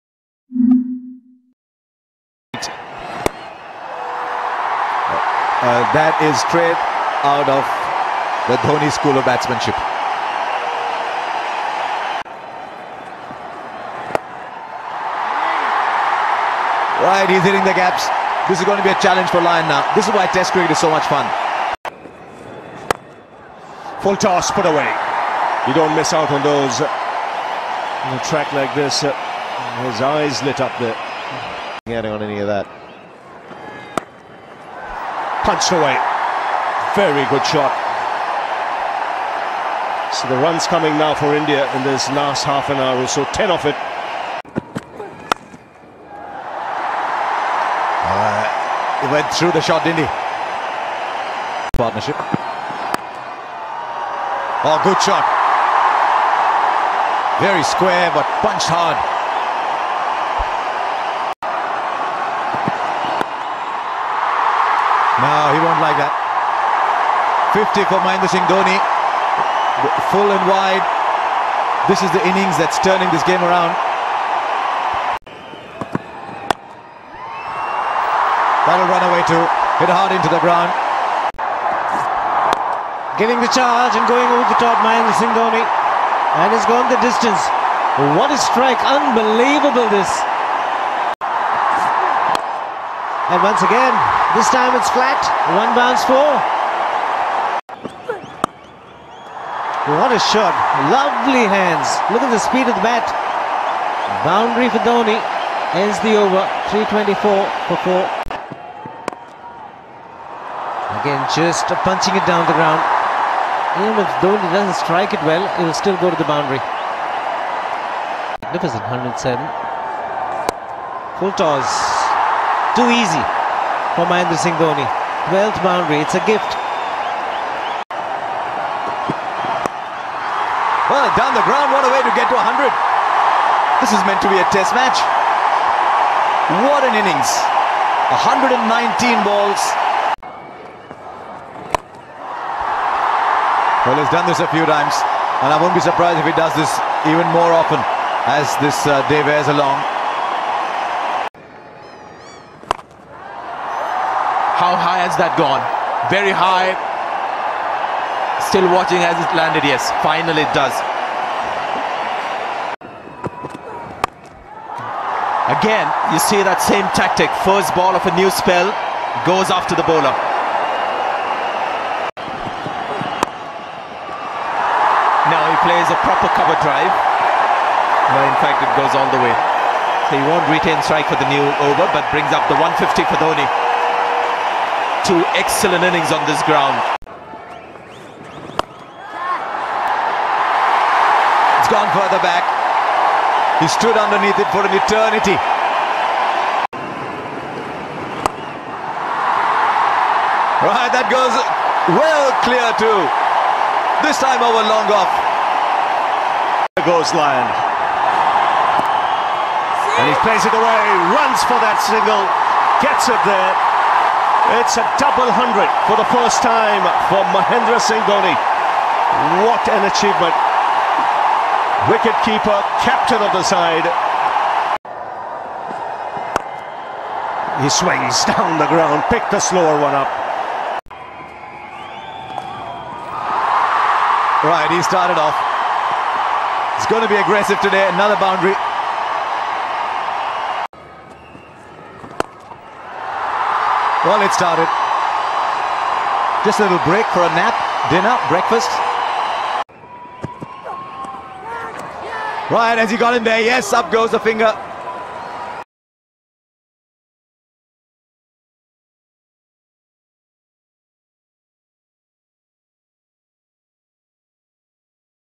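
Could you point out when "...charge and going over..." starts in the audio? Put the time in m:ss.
1:23.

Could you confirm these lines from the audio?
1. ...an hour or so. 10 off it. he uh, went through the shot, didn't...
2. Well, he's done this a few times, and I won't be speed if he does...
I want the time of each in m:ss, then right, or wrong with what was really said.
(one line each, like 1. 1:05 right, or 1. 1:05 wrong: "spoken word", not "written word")
1. 0:42 right
2. 2:23 wrong: "surprised", not "speed".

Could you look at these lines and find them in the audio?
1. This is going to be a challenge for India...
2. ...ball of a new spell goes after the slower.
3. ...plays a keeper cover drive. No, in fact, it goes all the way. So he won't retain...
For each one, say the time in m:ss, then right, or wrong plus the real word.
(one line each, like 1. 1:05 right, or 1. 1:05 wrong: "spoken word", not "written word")
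1. 0:18 wrong: "Lyon", not "India"
2. 2:47 wrong: "bowler", not "slower"
3. 2:55 wrong: "proper", not "keeper".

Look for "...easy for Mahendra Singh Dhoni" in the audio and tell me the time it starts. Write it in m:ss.
2:03.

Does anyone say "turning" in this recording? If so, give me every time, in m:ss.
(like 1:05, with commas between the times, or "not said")
1:12.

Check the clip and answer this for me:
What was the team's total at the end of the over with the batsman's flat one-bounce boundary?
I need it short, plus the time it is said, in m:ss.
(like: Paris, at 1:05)
324 for 4, at 1:46.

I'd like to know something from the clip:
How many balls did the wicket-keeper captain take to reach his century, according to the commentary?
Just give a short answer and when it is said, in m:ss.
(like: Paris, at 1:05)
119, at 2:18.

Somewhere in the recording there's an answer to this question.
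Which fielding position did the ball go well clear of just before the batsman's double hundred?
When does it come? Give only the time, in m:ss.
3:24.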